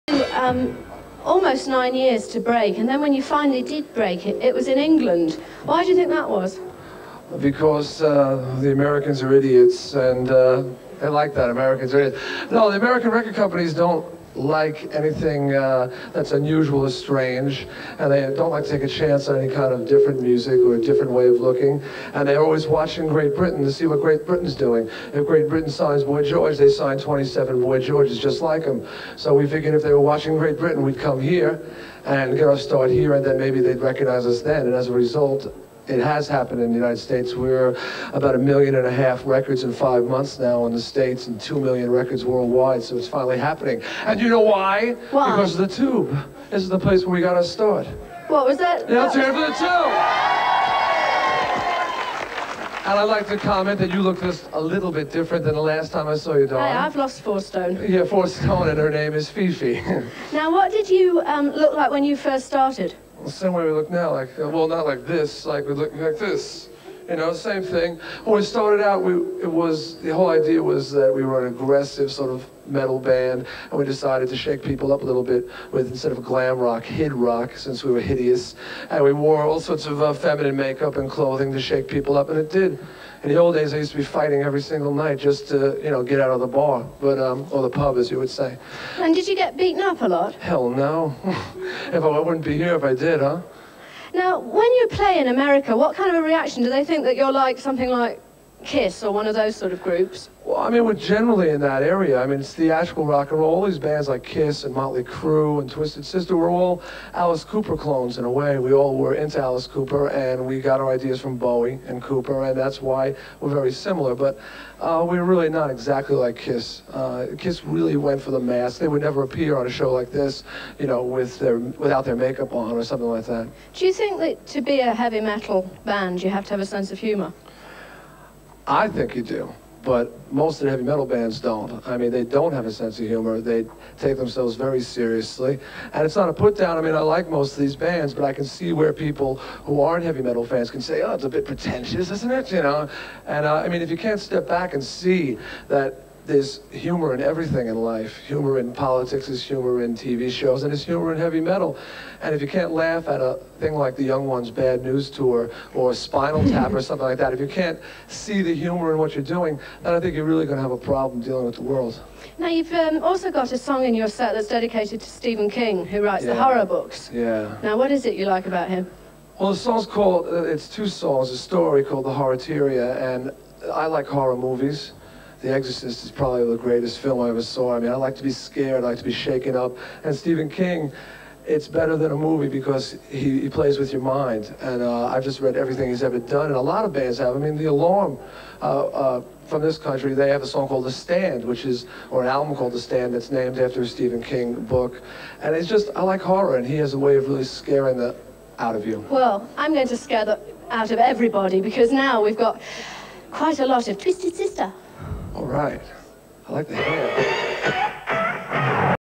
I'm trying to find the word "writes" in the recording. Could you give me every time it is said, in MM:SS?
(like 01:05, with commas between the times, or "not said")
02:46.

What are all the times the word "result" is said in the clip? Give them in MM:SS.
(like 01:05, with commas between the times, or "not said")
00:34.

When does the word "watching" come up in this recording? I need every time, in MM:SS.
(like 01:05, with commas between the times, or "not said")
00:22, 00:30.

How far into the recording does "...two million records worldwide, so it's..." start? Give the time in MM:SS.
00:41.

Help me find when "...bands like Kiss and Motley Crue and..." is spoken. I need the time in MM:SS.
01:43.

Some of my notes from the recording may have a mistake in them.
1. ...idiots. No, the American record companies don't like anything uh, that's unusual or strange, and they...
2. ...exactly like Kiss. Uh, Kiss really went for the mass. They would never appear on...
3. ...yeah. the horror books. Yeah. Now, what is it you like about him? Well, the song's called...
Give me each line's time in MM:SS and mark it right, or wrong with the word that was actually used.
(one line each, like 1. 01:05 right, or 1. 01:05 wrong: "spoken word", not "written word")
1. 00:12 right
2. 01:55 right
3. 02:46 right.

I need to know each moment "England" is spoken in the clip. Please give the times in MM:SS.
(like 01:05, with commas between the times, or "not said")
00:04.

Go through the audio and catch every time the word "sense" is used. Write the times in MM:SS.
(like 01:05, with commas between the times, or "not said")
02:06, 02:12.